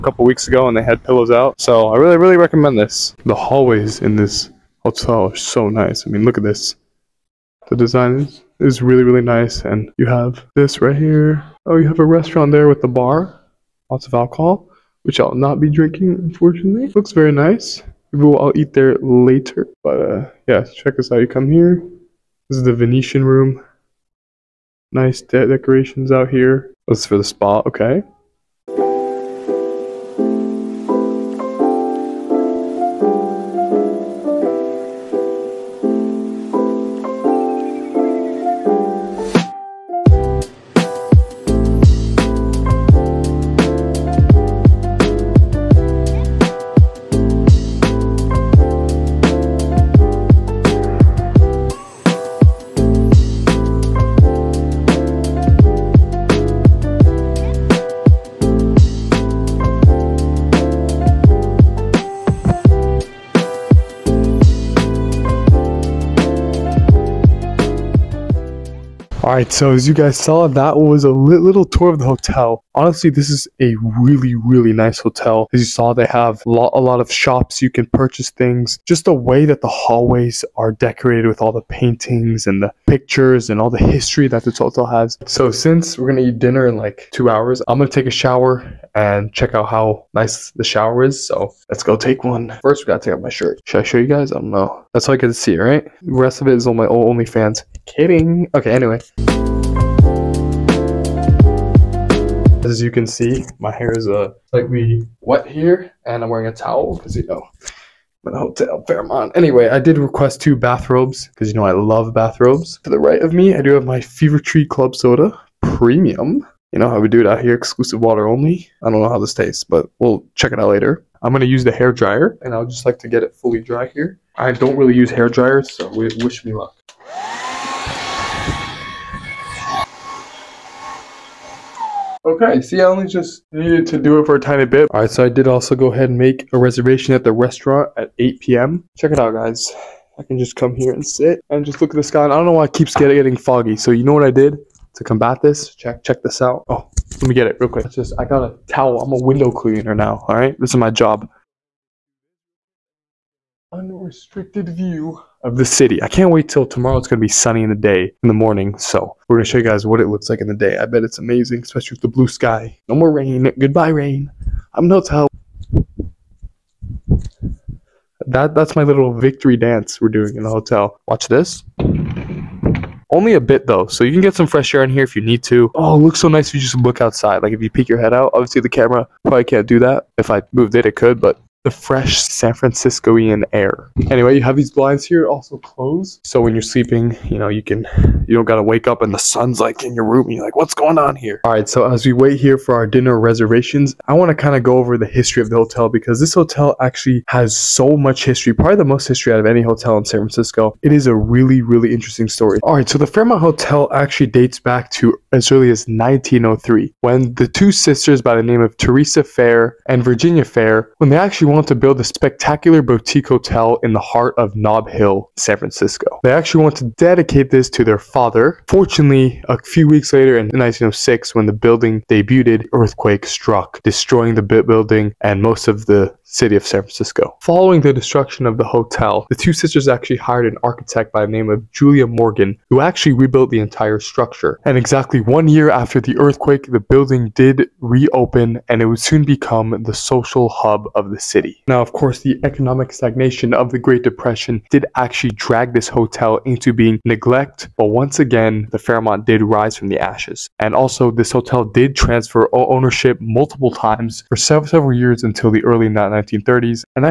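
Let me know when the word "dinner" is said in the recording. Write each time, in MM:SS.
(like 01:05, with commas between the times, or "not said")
01:26, 03:12.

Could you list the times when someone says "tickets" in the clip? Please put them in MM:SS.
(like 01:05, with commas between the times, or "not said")
not said.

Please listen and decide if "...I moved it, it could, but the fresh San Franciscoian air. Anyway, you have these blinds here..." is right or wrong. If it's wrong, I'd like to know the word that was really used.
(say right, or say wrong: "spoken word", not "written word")
right.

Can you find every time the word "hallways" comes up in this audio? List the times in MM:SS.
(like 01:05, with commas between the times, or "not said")
00:03, 01:19.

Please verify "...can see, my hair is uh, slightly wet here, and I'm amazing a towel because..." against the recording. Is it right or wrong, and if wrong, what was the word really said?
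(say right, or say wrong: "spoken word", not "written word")
wrong: "wearing", not "amazing".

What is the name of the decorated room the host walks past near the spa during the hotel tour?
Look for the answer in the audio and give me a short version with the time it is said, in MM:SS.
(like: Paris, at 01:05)
Venetian room, at 00:22.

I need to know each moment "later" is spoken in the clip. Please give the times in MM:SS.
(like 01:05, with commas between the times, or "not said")
00:18, 02:00, 03:40.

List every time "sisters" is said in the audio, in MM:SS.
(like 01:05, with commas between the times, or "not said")
03:27, 03:49.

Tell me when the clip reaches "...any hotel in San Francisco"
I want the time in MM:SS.
03:19.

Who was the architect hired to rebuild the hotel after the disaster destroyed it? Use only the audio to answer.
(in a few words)
Julia Morgan.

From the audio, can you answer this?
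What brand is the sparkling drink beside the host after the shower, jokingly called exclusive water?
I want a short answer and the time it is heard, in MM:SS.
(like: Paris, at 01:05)
Fever Tree, at 01:54.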